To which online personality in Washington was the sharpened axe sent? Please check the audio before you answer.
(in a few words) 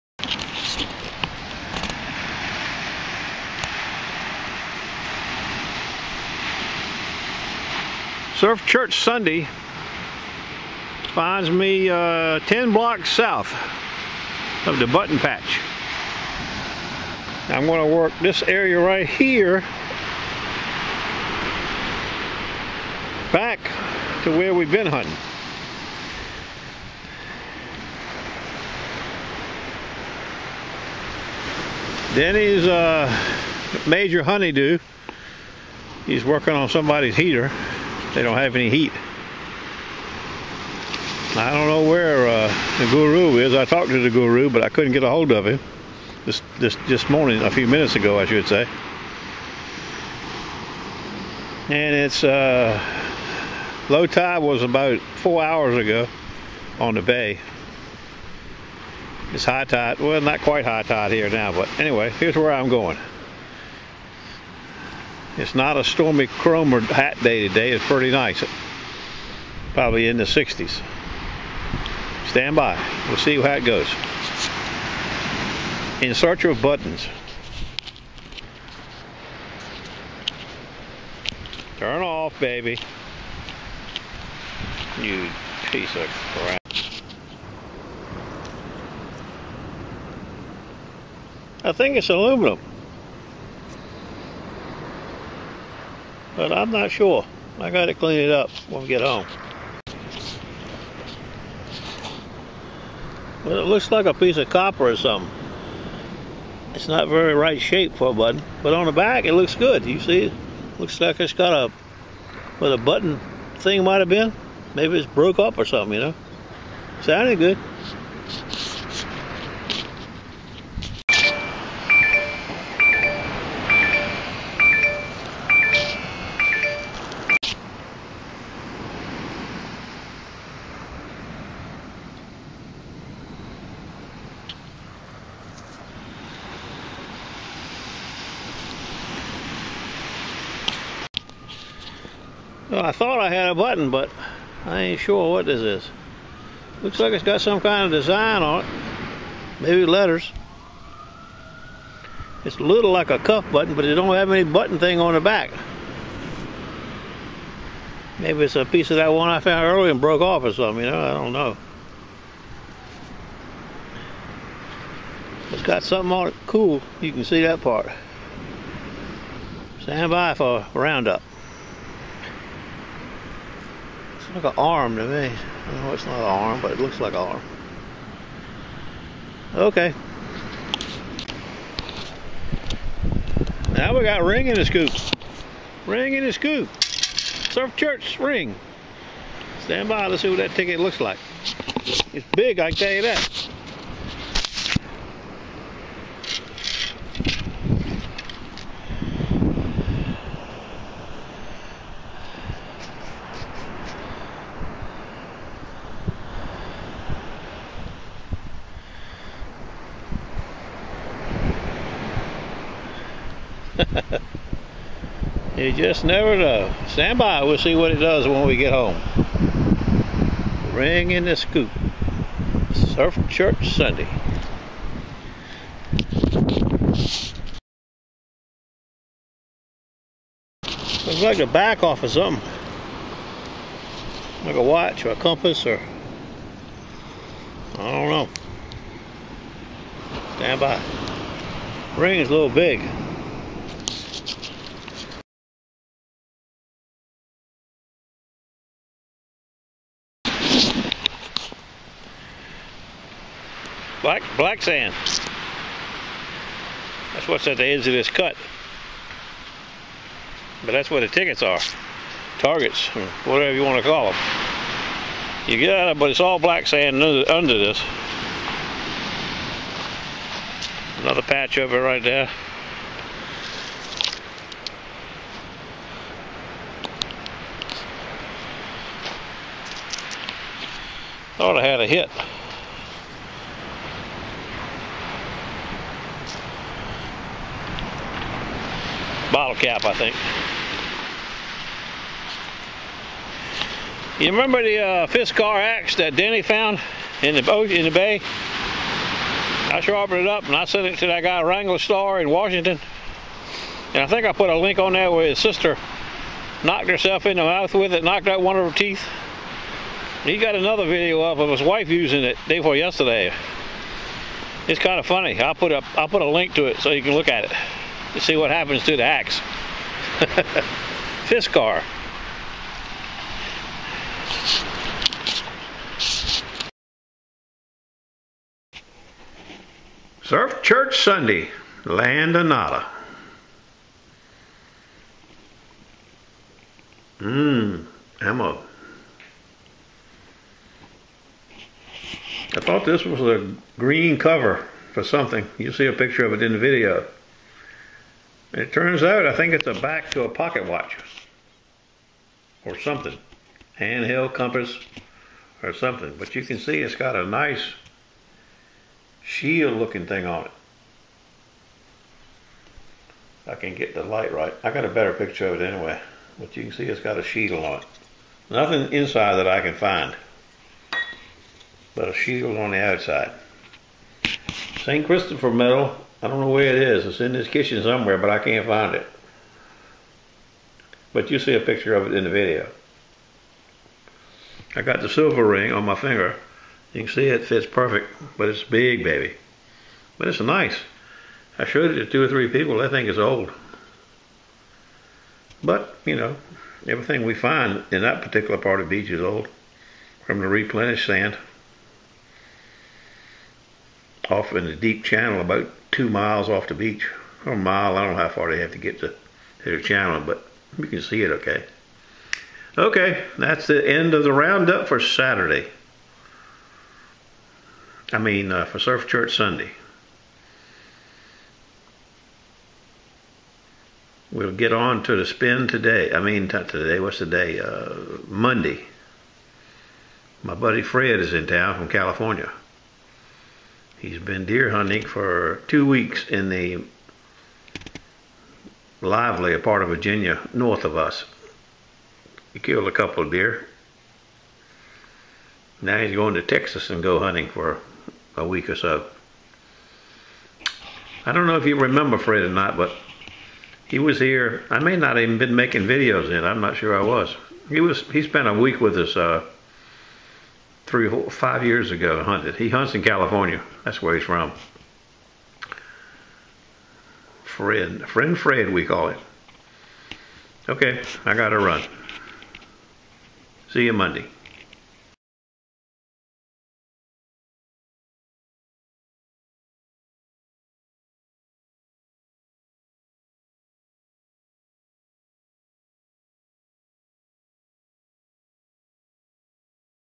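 Wranglerstar.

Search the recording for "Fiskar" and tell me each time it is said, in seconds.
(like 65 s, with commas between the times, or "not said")
295 s, 321 s.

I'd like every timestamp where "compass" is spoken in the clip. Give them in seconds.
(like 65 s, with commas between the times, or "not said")
235 s, 354 s.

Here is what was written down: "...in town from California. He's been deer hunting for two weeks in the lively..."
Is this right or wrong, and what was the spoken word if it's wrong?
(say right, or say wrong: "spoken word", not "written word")
right.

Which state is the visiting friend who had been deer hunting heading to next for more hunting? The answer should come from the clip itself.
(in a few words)
Texas.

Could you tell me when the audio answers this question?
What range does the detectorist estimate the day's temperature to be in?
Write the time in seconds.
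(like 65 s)
70 s.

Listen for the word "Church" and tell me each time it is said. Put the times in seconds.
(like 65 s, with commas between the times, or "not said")
8 s, 187 s, 223 s, 330 s, 419 s.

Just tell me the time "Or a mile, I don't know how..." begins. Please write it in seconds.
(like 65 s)
407 s.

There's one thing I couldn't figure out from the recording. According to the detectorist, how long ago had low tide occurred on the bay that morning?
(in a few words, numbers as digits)
four hours.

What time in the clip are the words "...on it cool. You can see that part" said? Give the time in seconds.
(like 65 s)
166 s.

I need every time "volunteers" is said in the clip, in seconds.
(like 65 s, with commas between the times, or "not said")
not said.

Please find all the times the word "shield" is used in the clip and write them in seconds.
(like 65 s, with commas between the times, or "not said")
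359 s, 367 s, 372 s.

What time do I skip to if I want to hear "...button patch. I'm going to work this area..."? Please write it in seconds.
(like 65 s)
14 s.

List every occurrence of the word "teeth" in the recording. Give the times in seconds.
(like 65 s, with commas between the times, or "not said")
308 s.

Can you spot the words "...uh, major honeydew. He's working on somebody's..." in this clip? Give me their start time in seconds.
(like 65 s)
32 s.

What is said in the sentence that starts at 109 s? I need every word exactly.
You see, looks like it's got a, what a button thing might have been.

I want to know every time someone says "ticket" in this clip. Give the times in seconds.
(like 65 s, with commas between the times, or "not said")
190 s, 261 s.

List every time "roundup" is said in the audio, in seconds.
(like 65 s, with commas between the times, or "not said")
170 s, 414 s.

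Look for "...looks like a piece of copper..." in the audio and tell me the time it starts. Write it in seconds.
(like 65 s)
103 s.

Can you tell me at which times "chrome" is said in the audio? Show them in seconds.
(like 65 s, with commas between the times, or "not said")
66 s.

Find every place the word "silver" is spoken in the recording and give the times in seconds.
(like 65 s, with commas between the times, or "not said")
385 s.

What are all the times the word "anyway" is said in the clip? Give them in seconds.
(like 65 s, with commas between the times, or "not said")
61 s, 365 s.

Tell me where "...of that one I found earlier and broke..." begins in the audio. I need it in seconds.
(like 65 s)
158 s.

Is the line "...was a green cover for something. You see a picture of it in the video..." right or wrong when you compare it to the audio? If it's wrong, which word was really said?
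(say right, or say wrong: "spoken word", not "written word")
right.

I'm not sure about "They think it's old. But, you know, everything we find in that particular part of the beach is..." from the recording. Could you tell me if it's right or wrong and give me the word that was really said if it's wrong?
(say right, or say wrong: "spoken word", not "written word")
right.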